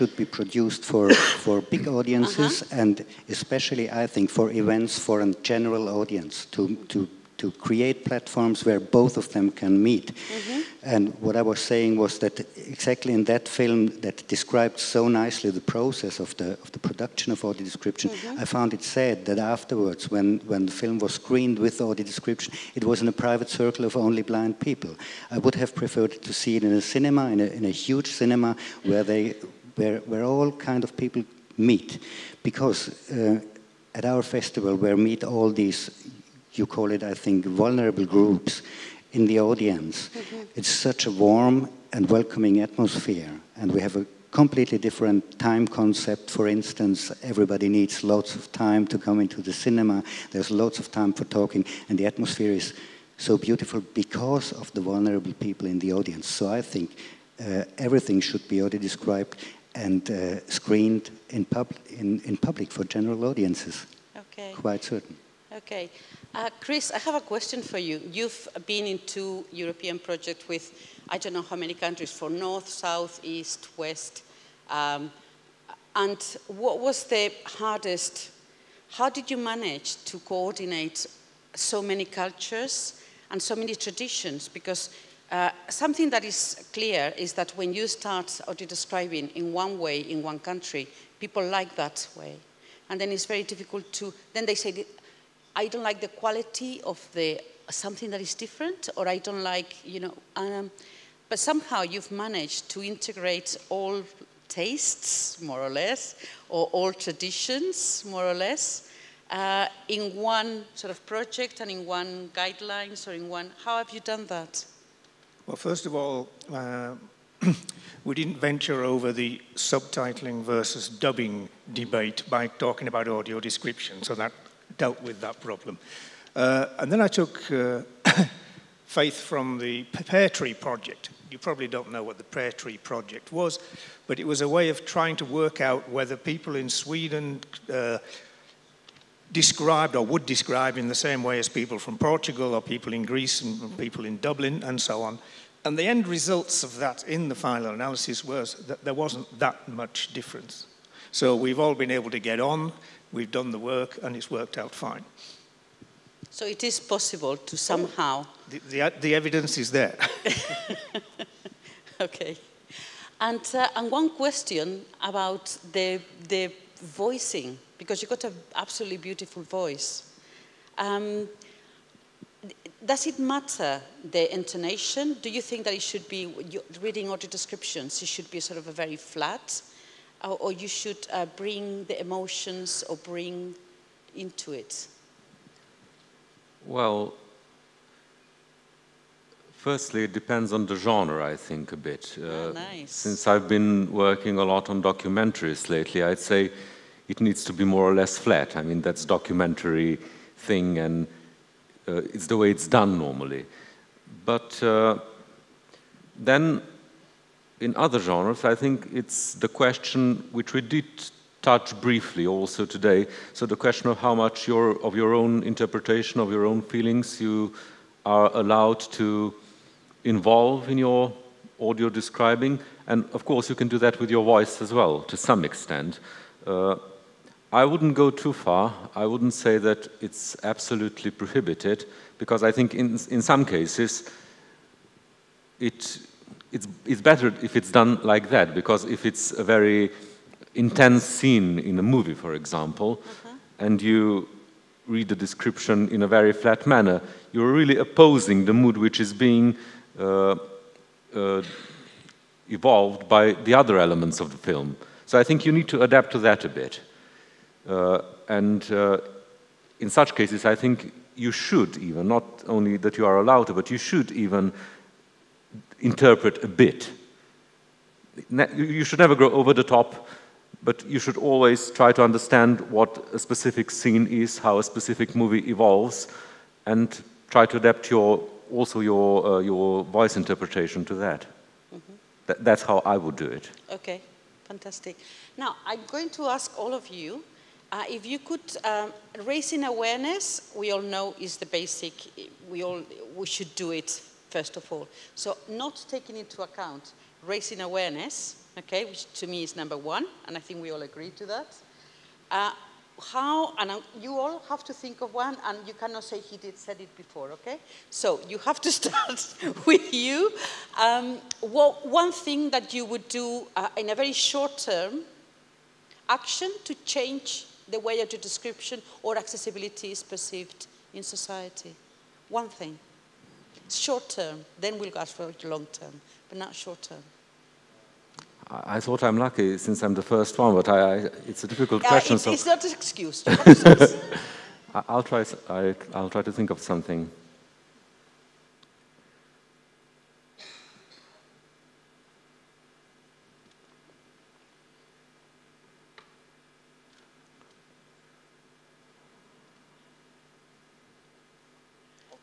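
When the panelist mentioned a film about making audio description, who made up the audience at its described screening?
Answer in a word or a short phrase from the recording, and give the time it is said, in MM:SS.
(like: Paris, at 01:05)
Only blind people, at 00:23.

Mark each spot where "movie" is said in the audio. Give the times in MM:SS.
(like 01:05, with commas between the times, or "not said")
04:01, 04:35.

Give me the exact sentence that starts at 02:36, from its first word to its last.
So it is possible to somehow.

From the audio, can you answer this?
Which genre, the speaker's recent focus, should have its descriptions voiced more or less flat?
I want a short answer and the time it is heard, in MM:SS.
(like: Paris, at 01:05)
Documentaries, at 03:14.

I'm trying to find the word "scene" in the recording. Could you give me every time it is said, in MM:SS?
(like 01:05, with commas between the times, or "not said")
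04:01, 04:33.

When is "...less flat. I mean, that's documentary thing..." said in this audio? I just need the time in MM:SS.
03:17.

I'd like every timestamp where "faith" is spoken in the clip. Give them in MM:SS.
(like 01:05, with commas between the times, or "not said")
02:08.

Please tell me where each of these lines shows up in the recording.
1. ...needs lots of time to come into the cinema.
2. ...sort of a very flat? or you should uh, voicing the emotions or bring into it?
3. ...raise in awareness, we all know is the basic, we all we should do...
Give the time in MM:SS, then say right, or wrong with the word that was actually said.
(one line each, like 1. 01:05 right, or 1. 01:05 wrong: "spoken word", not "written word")
1. 00:47 right
2. 02:58 wrong: "bring", not "voicing"
3. 04:49 right.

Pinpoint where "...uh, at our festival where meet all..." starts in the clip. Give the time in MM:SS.
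00:33.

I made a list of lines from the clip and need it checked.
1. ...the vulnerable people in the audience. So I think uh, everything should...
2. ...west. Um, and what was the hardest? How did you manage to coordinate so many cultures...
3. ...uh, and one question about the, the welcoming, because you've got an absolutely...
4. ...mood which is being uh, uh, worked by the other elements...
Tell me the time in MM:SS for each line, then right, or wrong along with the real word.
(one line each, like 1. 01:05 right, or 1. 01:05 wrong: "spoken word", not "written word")
1. 00:54 right
2. 01:13 right
3. 02:43 wrong: "voicing", not "welcoming"
4. 04:08 wrong: "evolved", not "worked".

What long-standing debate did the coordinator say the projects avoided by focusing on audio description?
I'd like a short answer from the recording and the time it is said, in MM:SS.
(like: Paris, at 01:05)
Subtitling versus dubbing, at 01:59.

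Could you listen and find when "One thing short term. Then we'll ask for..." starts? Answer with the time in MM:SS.
05:22.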